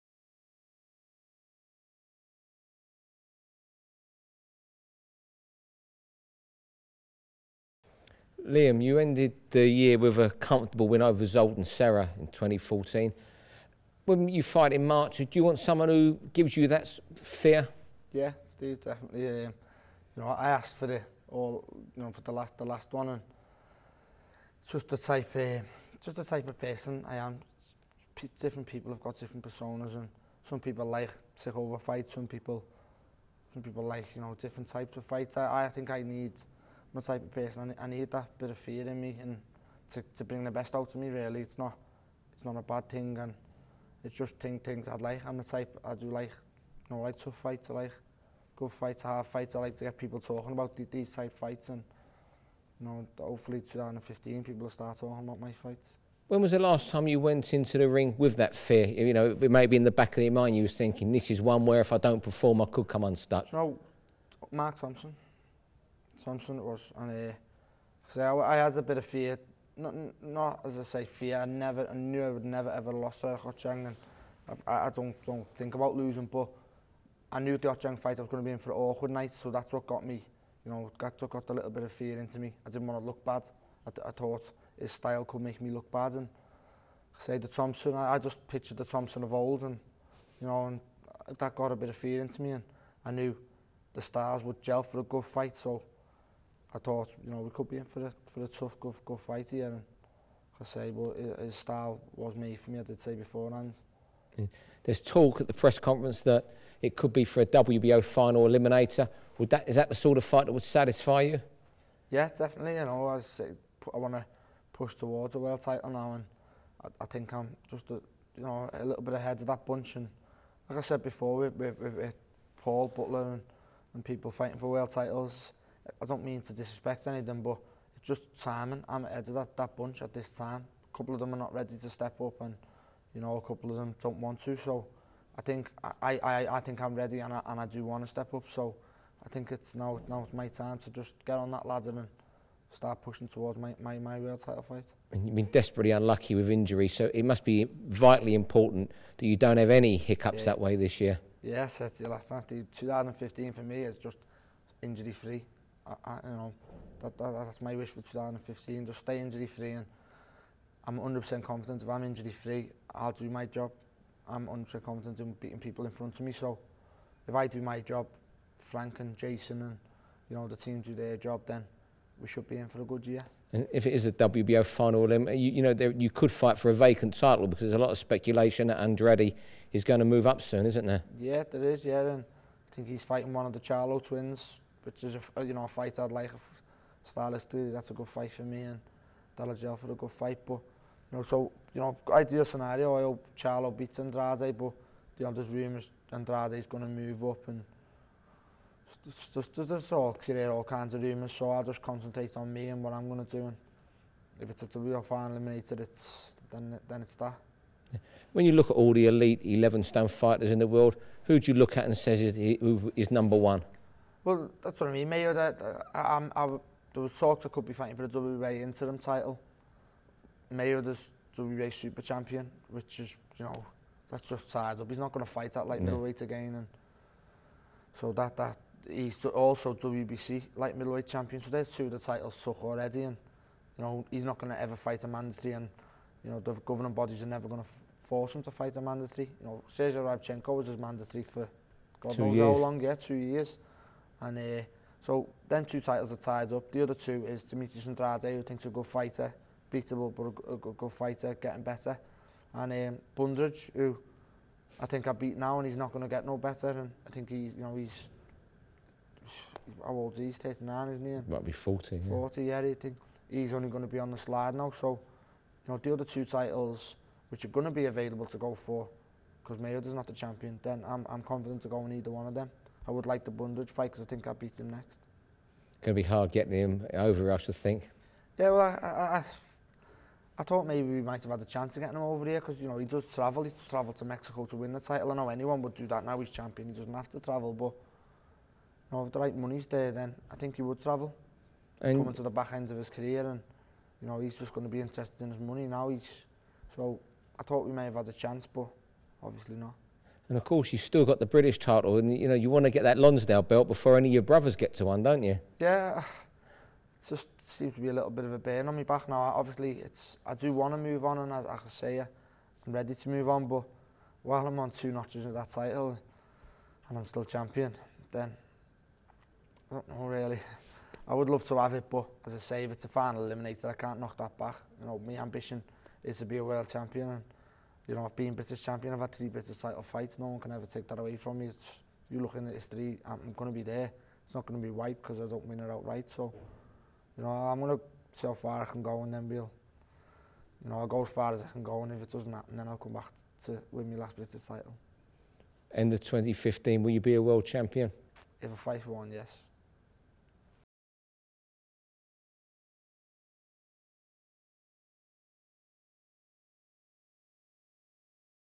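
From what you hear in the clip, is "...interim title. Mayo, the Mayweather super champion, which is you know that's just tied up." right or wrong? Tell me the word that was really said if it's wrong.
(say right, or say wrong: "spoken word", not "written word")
wrong: "WBA", not "Mayweather".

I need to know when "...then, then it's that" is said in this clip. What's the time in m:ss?
3:26.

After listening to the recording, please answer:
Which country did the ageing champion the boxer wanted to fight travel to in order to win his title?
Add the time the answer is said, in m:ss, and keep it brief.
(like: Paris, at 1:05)
Mexico, at 4:44.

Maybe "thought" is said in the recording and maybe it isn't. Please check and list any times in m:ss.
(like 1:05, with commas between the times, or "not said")
1:24, 1:36, 4:40, 4:57.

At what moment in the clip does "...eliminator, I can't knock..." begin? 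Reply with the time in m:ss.
5:23.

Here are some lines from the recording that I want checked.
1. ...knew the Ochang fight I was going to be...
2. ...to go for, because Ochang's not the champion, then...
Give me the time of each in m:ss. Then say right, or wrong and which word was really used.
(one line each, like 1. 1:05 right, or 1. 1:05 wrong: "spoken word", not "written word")
1. 1:17 right
2. 4:28 wrong: "Mayweather", not "Ochang".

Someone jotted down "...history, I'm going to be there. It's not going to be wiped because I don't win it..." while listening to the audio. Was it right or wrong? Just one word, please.
right.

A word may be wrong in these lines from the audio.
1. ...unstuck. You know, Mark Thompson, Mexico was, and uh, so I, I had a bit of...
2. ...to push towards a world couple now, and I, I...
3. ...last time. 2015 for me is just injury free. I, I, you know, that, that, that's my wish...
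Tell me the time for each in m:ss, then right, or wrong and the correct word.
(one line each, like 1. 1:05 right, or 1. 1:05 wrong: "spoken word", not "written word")
1. 1:03 wrong: "Thompson", not "Mexico"
2. 1:54 wrong: "title", not "couple"
3. 2:32 right.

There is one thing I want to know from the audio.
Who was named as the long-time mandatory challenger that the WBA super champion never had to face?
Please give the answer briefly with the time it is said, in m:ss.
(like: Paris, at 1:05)
Sergei Rabchenko, at 3:59.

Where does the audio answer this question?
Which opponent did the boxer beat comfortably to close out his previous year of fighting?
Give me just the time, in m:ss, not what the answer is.
0:11.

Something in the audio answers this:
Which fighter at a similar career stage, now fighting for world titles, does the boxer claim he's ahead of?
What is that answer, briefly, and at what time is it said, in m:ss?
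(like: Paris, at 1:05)
Paul Butler, at 2:02.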